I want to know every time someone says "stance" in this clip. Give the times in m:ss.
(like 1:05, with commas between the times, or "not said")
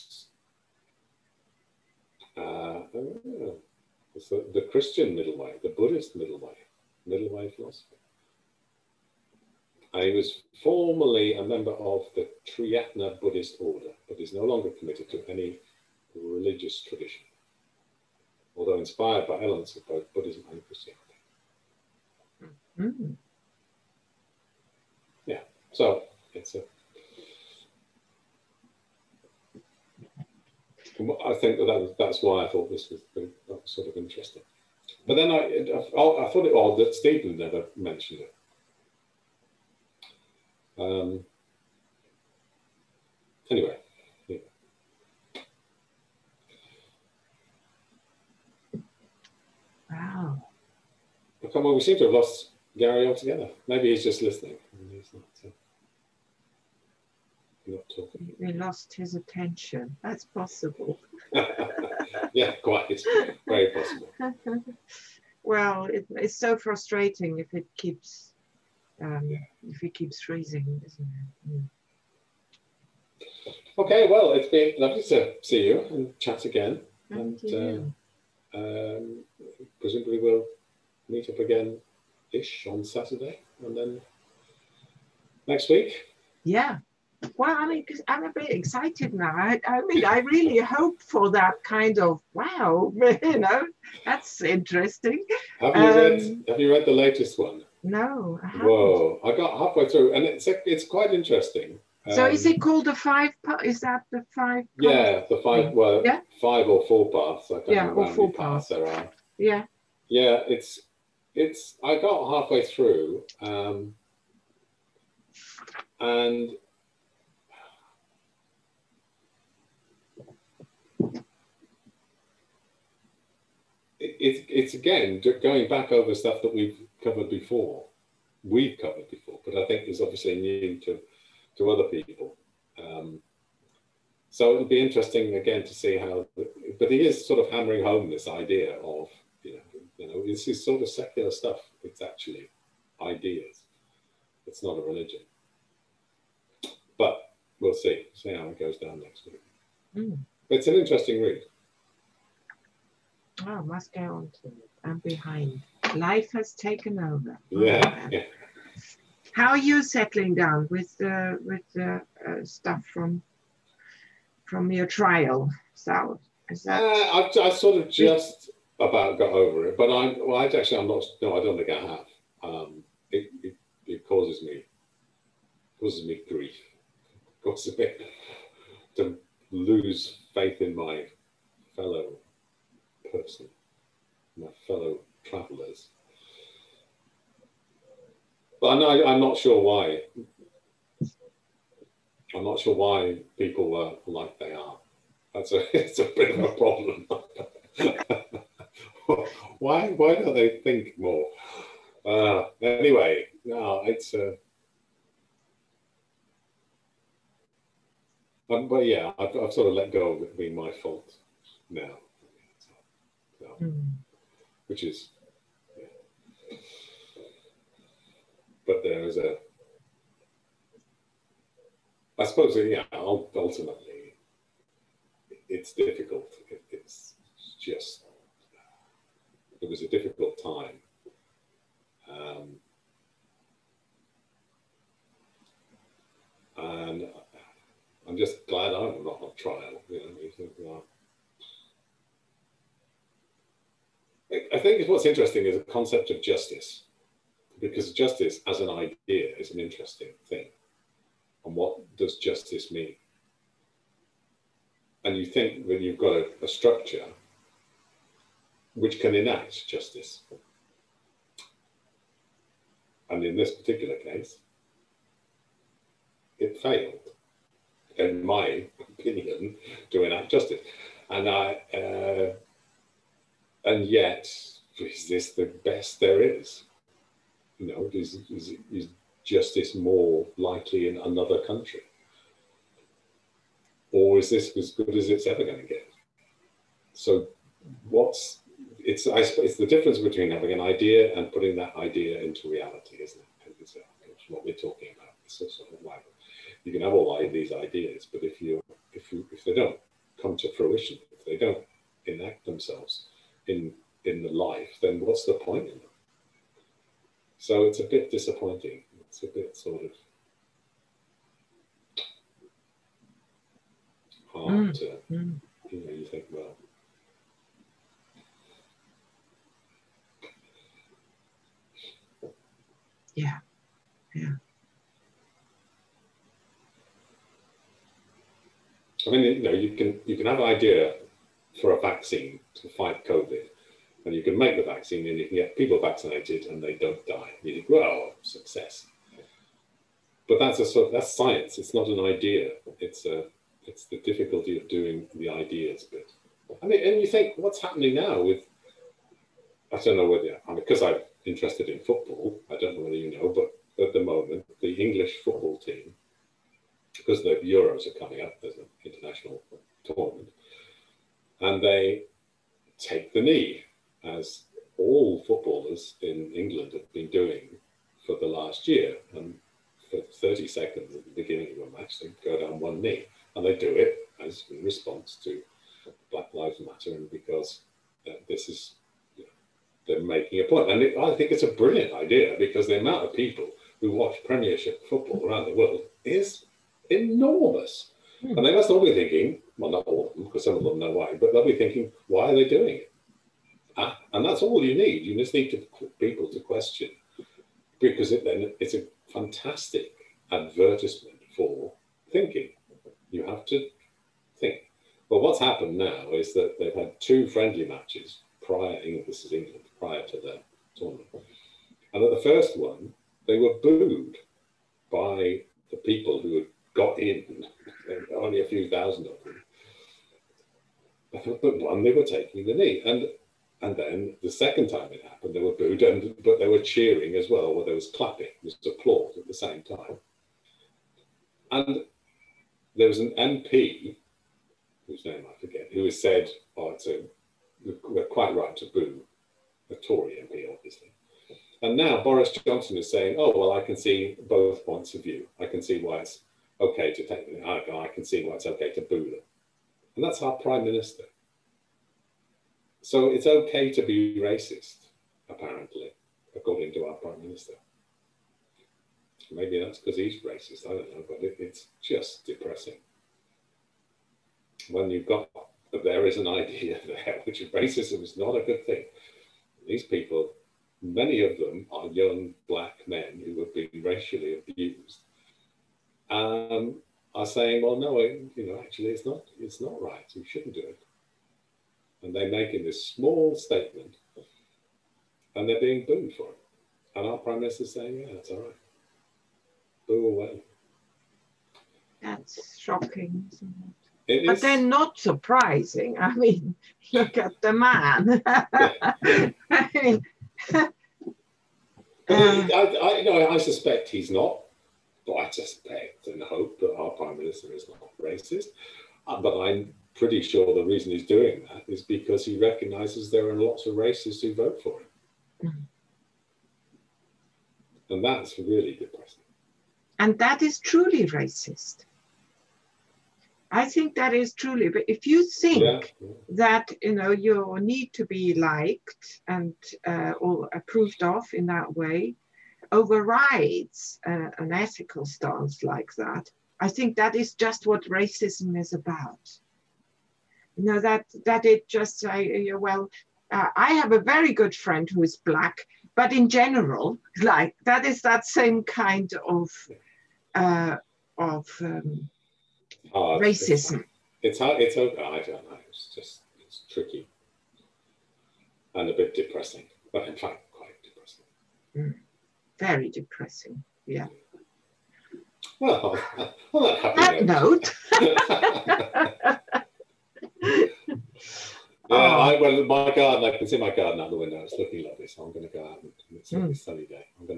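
8:55.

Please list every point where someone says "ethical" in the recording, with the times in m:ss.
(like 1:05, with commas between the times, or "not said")
8:54.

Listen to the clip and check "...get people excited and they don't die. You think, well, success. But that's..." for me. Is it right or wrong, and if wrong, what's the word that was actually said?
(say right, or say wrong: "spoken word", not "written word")
wrong: "vaccinated", not "excited".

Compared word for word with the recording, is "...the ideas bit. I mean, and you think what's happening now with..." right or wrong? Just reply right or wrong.
right.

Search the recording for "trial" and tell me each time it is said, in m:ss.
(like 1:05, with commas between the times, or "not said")
2:44, 3:59.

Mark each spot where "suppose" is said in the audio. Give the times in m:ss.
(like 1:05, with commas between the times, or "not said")
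3:42.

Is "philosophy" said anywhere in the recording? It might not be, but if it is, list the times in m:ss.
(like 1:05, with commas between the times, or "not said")
0:07.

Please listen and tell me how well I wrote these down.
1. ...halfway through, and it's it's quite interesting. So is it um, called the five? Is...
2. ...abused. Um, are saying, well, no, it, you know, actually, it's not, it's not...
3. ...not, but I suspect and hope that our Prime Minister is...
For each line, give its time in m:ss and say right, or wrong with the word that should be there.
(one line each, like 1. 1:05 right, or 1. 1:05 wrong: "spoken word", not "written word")
1. 1:39 right
2. 7:54 right
3. 8:24 right.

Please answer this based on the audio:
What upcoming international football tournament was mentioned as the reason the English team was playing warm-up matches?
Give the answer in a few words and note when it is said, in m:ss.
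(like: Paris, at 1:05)
The Euros, at 5:57.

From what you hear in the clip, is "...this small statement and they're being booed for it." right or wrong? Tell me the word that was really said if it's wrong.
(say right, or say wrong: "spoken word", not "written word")
right.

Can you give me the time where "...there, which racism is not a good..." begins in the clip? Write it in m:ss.
7:46.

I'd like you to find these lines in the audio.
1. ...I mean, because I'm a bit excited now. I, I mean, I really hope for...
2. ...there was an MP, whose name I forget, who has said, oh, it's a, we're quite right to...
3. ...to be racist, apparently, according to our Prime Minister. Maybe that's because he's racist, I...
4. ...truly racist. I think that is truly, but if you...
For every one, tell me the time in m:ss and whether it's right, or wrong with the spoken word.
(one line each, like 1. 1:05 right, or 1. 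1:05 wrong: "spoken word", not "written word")
1. 1:27 right
2. 7:12 right
3. 7:33 right
4. 8:40 right.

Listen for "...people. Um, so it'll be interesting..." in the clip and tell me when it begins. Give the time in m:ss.
2:11.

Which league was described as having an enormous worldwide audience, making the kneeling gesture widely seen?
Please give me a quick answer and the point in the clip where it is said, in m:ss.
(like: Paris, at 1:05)
Premiership, at 6:24.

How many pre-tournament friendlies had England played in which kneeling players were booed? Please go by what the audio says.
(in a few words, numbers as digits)
2.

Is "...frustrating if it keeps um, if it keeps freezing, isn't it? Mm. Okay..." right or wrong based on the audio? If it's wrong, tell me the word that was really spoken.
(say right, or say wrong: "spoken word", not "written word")
right.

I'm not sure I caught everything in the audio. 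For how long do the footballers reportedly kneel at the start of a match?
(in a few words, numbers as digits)
30 seconds.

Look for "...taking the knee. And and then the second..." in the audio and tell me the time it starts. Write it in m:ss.
7:02.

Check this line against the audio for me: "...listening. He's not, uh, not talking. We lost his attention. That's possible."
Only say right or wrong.
right.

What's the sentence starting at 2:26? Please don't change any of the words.
But we'll see, see how it goes down next week.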